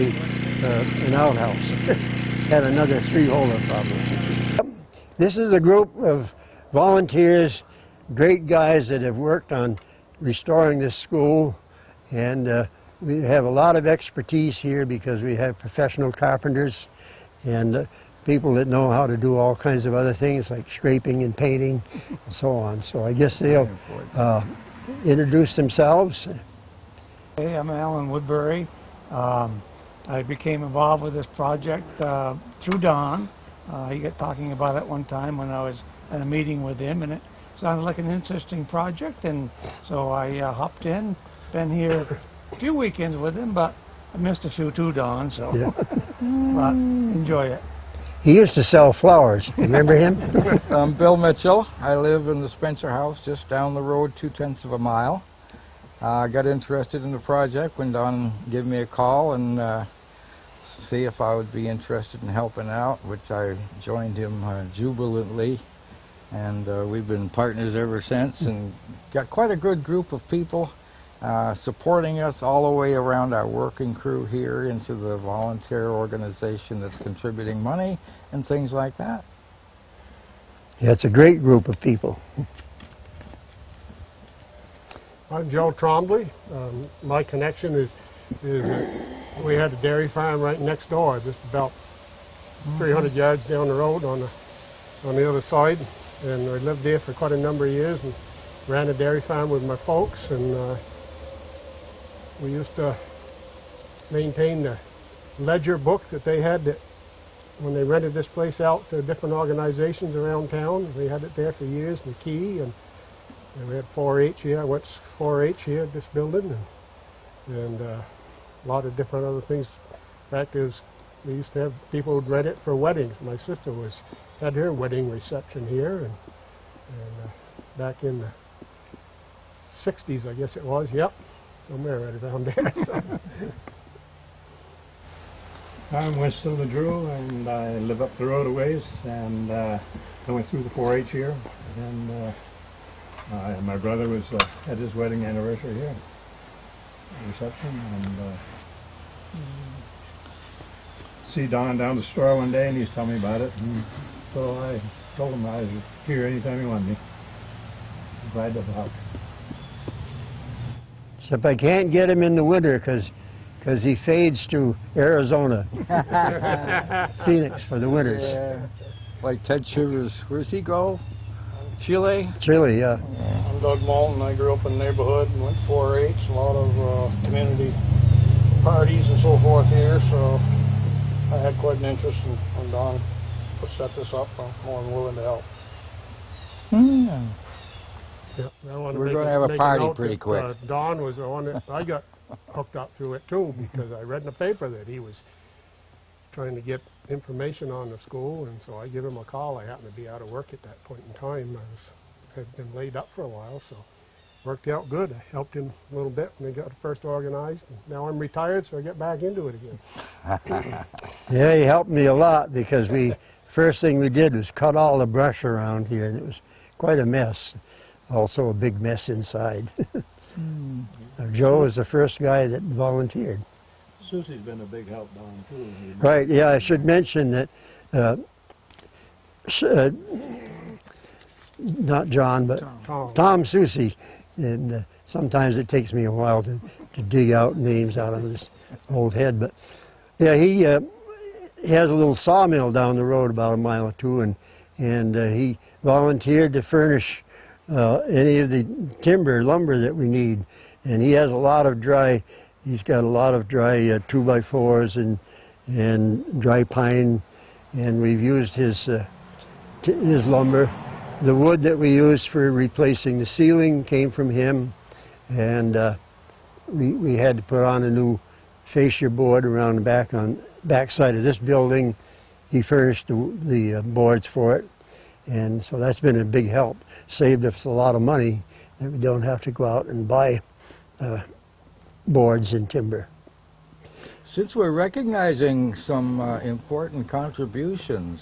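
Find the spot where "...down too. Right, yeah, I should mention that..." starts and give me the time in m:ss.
3:45.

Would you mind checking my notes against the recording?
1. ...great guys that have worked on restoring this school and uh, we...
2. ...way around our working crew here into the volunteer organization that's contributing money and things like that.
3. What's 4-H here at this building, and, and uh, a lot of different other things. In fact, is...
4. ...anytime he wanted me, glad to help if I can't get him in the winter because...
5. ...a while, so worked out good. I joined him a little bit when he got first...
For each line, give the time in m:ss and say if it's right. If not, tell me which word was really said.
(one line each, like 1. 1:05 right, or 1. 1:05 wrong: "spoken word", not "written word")
1. 0:08 right
2. 1:12 right
3. 1:54 right
4. 2:36 right
5. 3:23 wrong: "helped", not "joined".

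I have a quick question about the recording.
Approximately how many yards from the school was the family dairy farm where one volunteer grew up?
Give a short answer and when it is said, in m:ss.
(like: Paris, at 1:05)
300 yards, at 1:32.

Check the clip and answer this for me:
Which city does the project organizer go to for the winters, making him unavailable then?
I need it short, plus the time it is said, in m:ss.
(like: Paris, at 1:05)
Phoenix, at 2:47.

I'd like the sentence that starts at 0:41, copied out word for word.
Been here a few weekends with him, but I missed a few too, Don, so yeah.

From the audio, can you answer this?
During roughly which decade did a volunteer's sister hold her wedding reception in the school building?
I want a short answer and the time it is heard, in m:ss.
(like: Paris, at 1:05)
the 60s, at 2:08.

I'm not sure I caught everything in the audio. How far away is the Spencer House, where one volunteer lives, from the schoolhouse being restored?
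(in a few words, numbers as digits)
2 tenths of a mile.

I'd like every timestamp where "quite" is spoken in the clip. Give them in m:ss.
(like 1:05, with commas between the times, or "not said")
1:09, 1:37, 3:01, 3:36.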